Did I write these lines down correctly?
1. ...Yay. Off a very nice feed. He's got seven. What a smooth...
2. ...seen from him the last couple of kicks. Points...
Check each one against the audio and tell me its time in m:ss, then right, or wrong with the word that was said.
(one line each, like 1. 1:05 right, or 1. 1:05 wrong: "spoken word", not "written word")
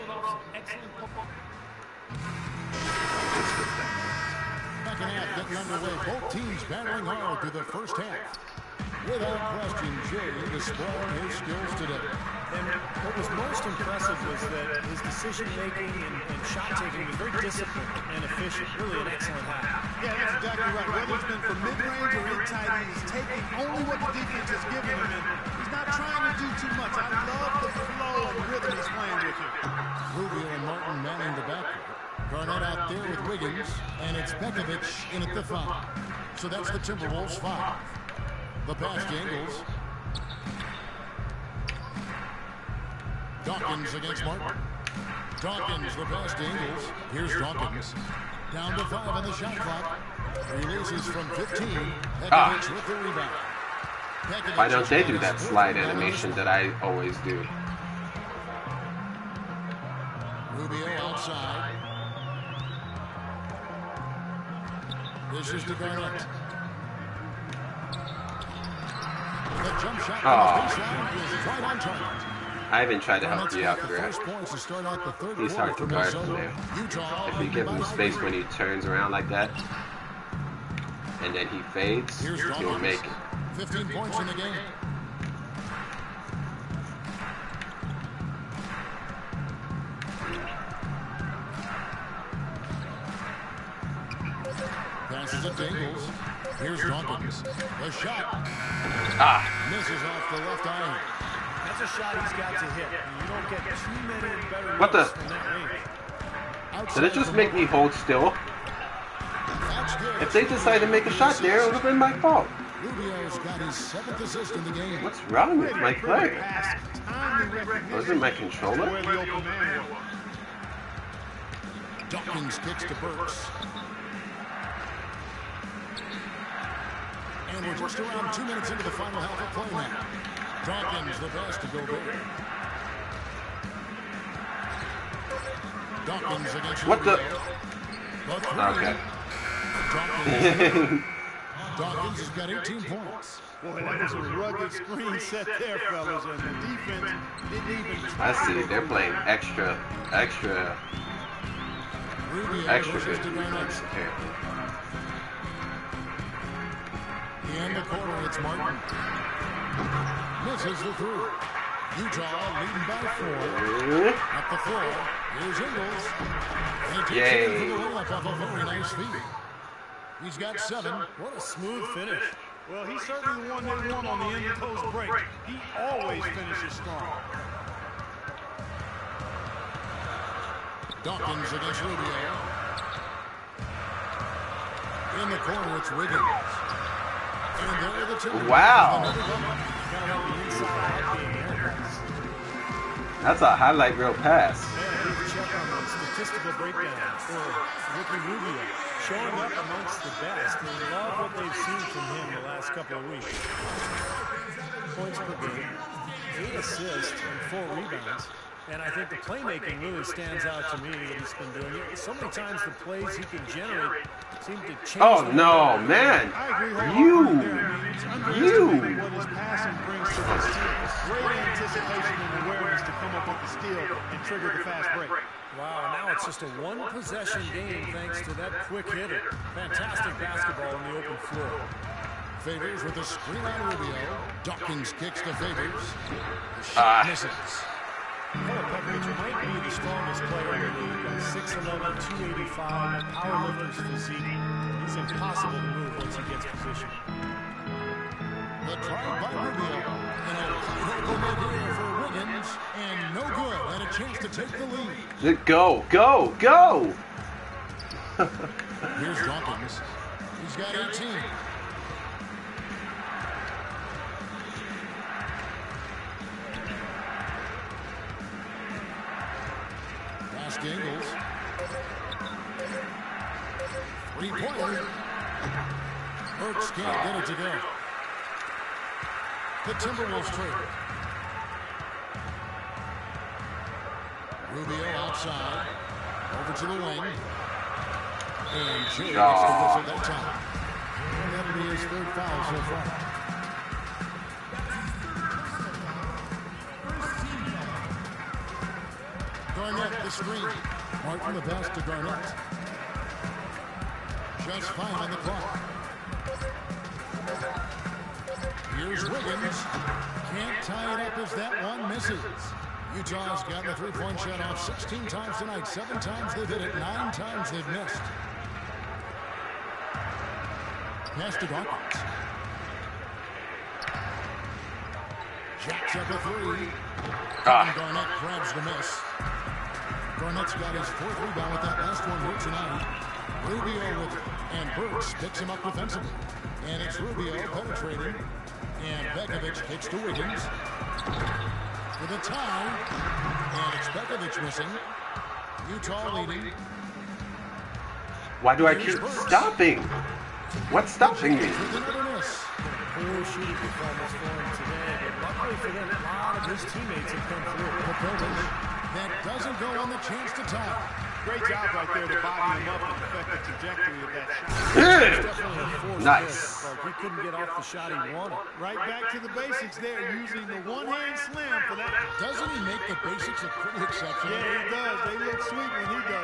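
1. 2:47 right
2. 3:21 wrong: "weeks", not "kicks".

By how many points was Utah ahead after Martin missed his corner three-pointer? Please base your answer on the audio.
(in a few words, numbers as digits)
4.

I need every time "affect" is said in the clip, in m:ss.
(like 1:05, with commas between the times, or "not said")
6:03.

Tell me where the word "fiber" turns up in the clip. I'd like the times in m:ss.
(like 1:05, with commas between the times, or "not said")
not said.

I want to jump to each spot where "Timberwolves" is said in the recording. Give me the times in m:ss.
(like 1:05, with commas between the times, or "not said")
0:36, 4:39.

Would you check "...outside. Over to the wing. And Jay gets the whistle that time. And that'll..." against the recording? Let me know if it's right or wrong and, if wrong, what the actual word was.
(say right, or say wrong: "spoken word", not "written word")
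right.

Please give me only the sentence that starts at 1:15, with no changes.
He's hard to guard from there.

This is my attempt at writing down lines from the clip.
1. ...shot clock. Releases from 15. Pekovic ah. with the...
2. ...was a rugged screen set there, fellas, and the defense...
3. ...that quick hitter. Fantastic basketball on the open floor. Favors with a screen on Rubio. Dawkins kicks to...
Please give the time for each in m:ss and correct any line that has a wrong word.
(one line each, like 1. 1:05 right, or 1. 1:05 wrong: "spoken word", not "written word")
1. 0:49 right
2. 2:24 right
3. 3:48 right.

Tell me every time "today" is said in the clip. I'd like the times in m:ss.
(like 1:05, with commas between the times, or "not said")
0:11, 5:54.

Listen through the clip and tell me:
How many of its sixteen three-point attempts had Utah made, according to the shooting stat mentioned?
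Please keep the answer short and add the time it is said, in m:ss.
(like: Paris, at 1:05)
7, at 5:15.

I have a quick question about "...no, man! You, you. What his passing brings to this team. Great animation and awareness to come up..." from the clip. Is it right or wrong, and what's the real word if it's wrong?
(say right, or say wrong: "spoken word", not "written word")
wrong: "anticipation", not "animation".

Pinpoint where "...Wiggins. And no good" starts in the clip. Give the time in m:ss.
4:12.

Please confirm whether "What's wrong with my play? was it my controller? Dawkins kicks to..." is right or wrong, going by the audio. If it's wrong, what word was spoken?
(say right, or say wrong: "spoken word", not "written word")
right.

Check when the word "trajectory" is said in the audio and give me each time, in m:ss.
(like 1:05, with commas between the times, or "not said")
6:03.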